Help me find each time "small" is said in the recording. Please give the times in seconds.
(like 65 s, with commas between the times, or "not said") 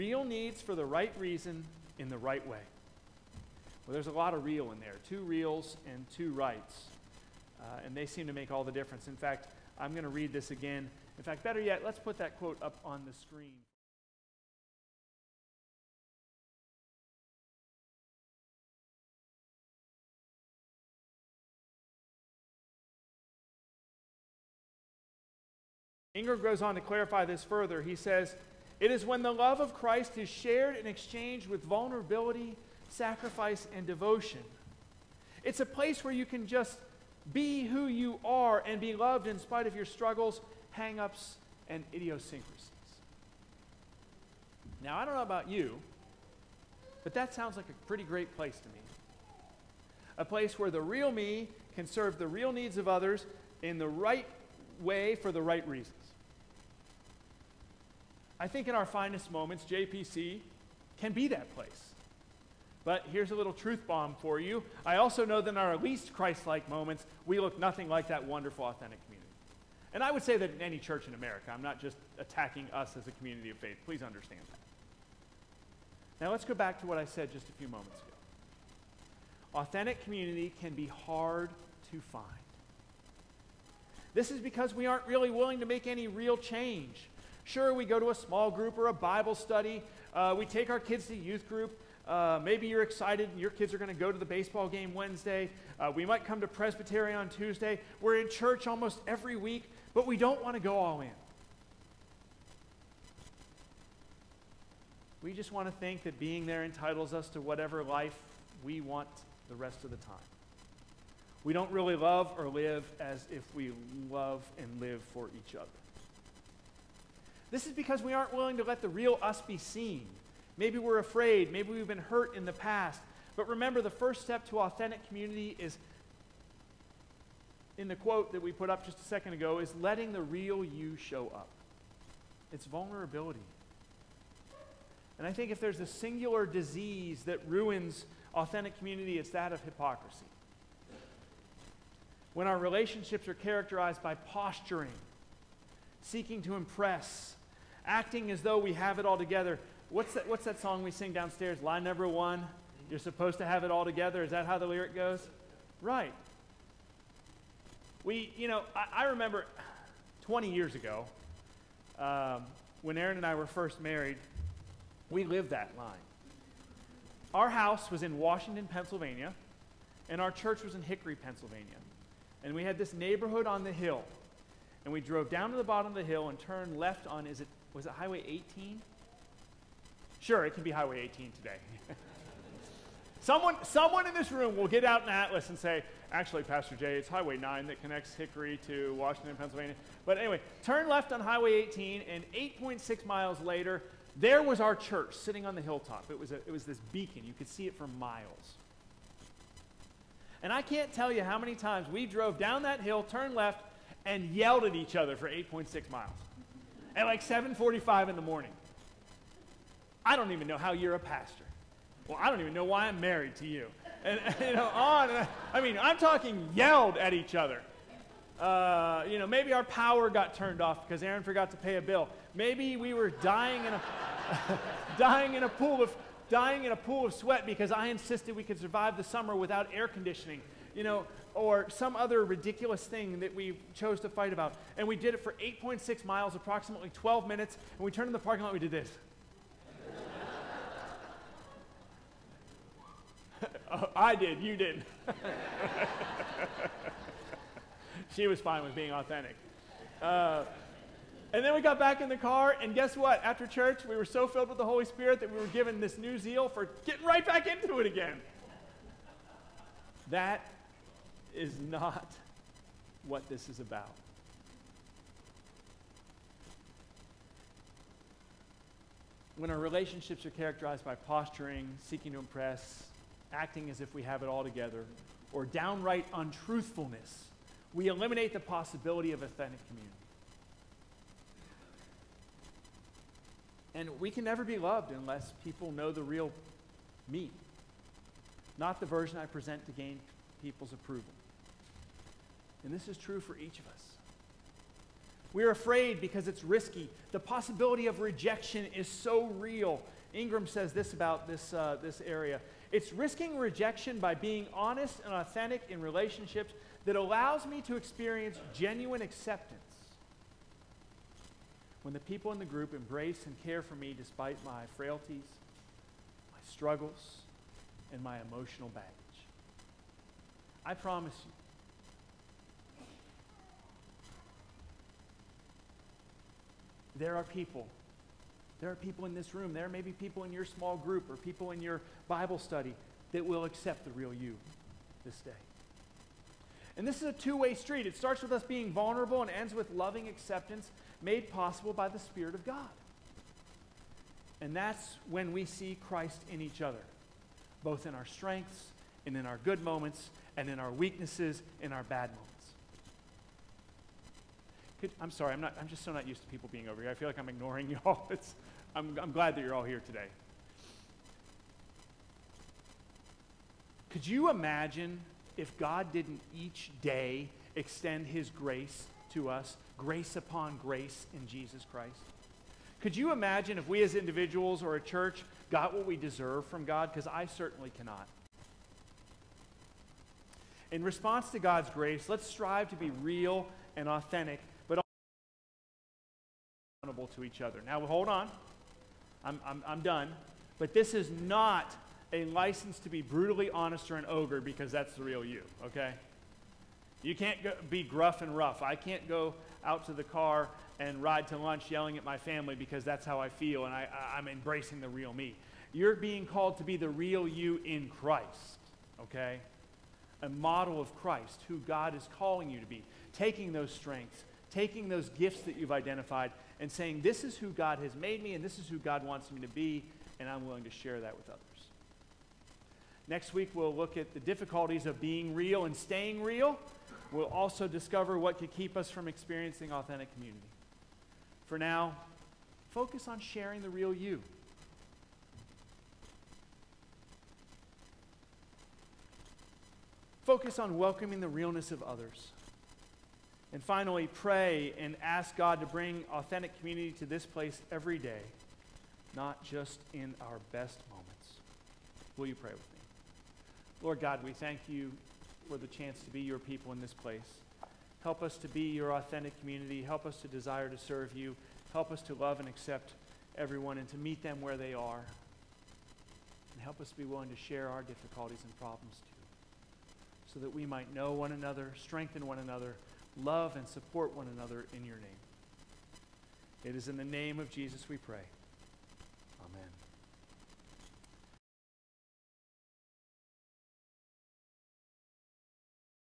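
88 s, 330 s.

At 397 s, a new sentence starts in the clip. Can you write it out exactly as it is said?
You can't go, be gruff and rough.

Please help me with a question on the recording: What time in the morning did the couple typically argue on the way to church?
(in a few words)
7:45.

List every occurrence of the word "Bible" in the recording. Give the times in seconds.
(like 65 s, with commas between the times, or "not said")
88 s, 332 s.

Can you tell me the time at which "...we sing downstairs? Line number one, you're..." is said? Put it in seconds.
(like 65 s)
150 s.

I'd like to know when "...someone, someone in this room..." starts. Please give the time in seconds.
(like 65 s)
183 s.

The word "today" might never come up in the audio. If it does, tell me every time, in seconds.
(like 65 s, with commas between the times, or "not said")
181 s, 359 s.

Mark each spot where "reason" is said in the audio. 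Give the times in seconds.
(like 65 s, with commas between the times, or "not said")
1 s, 55 s.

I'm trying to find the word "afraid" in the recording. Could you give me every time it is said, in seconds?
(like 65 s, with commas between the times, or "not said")
120 s, 295 s.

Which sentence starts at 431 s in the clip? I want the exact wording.
For now, focus on sharing the real you.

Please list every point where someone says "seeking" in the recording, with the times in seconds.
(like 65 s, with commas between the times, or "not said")
146 s, 271 s.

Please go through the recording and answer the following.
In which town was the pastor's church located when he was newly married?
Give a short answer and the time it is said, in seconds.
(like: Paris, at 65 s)
Hickory, Pennsylvania, at 170 s.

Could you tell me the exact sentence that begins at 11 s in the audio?
In fact, better yet, let's put that quote up on the screen.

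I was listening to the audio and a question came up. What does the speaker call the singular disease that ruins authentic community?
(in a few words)
hypocrisy.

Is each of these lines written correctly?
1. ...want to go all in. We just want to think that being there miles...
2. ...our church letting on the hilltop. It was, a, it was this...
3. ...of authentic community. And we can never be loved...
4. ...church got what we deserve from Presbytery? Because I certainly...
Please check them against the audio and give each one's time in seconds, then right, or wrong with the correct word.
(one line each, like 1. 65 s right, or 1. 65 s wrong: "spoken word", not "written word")
1. 100 s wrong: "entitles", not "miles"
2. 194 s wrong: "sitting", not "letting"
3. 279 s right
4. 374 s wrong: "God", not "Presbytery".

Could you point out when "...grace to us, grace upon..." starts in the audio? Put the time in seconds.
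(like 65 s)
368 s.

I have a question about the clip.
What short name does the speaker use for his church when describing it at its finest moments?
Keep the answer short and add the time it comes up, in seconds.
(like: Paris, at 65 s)
JPC, at 59 s.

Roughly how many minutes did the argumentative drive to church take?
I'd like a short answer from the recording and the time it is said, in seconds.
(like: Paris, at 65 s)
12, at 236 s.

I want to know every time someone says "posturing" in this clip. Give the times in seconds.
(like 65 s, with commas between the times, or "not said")
144 s, 270 s.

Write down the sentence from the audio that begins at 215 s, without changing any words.
I, mean, I'm talking yelled at each other.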